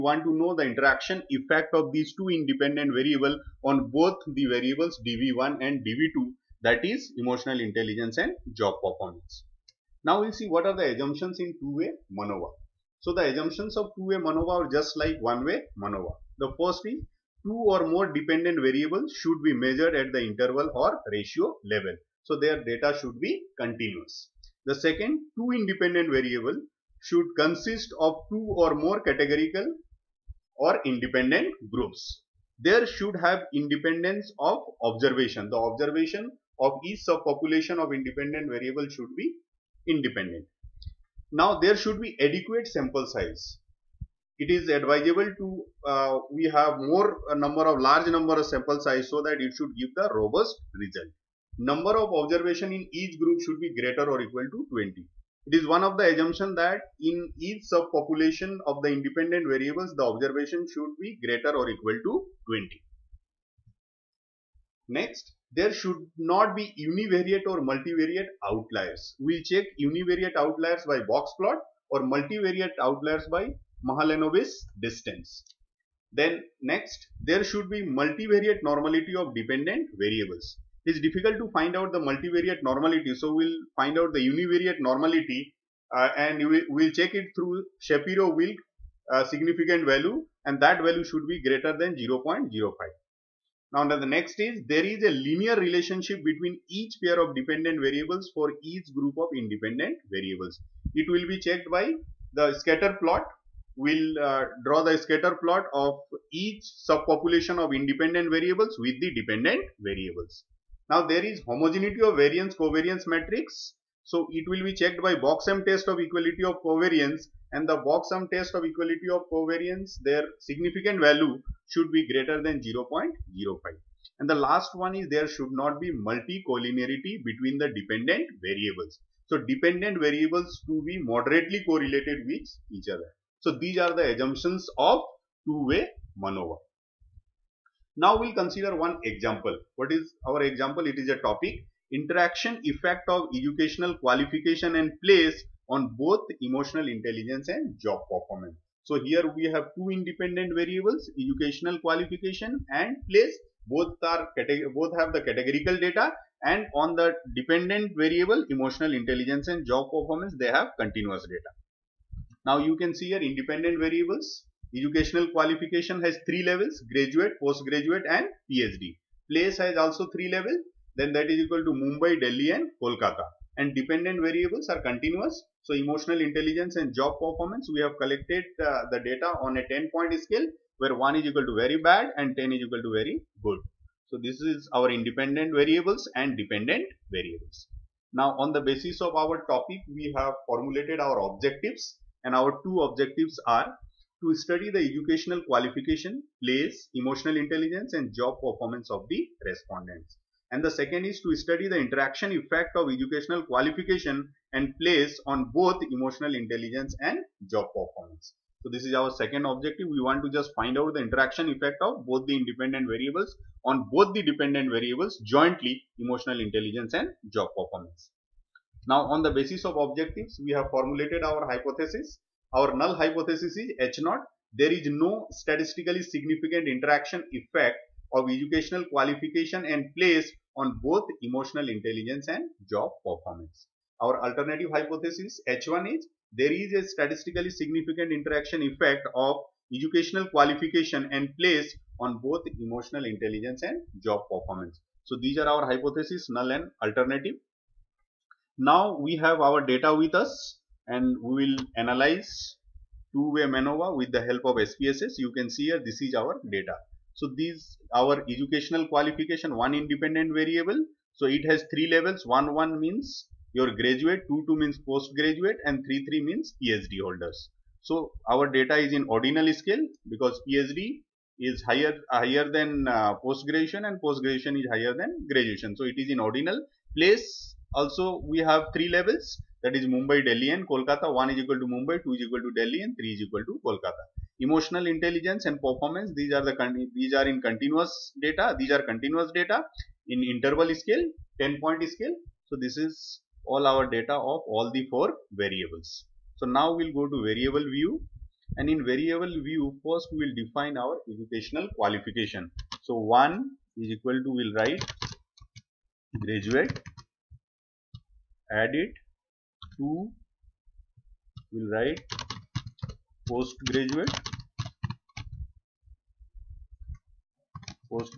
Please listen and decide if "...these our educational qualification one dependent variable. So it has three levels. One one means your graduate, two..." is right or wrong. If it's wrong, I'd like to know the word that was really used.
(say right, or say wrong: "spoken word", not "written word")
wrong: "independent", not "dependent".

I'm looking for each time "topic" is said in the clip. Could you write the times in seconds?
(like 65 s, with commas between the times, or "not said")
141 s, 189 s.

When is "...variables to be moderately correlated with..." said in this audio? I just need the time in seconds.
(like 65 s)
130 s.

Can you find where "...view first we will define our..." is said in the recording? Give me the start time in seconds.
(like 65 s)
299 s.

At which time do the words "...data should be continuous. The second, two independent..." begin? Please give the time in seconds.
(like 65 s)
22 s.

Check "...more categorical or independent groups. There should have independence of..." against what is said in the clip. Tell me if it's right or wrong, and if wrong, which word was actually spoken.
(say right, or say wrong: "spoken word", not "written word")
right.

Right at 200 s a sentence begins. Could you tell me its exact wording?
And the second is to study the interaction effect of educational qualification and place on both emotional intelligence and job performance.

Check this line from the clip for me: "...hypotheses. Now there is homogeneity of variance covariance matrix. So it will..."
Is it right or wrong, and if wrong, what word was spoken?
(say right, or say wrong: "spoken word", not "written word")
wrong: "variables", not "hypotheses".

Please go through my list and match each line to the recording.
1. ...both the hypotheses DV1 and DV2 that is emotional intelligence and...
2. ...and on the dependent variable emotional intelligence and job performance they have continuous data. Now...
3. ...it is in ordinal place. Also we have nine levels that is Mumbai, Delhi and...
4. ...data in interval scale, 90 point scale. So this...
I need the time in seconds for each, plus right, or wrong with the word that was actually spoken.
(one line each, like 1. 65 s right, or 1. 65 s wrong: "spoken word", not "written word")
1. 3 s wrong: "variables", not "hypotheses"
2. 156 s right
3. 275 s wrong: "three", not "nine"
4. 289 s wrong: "10", not "90".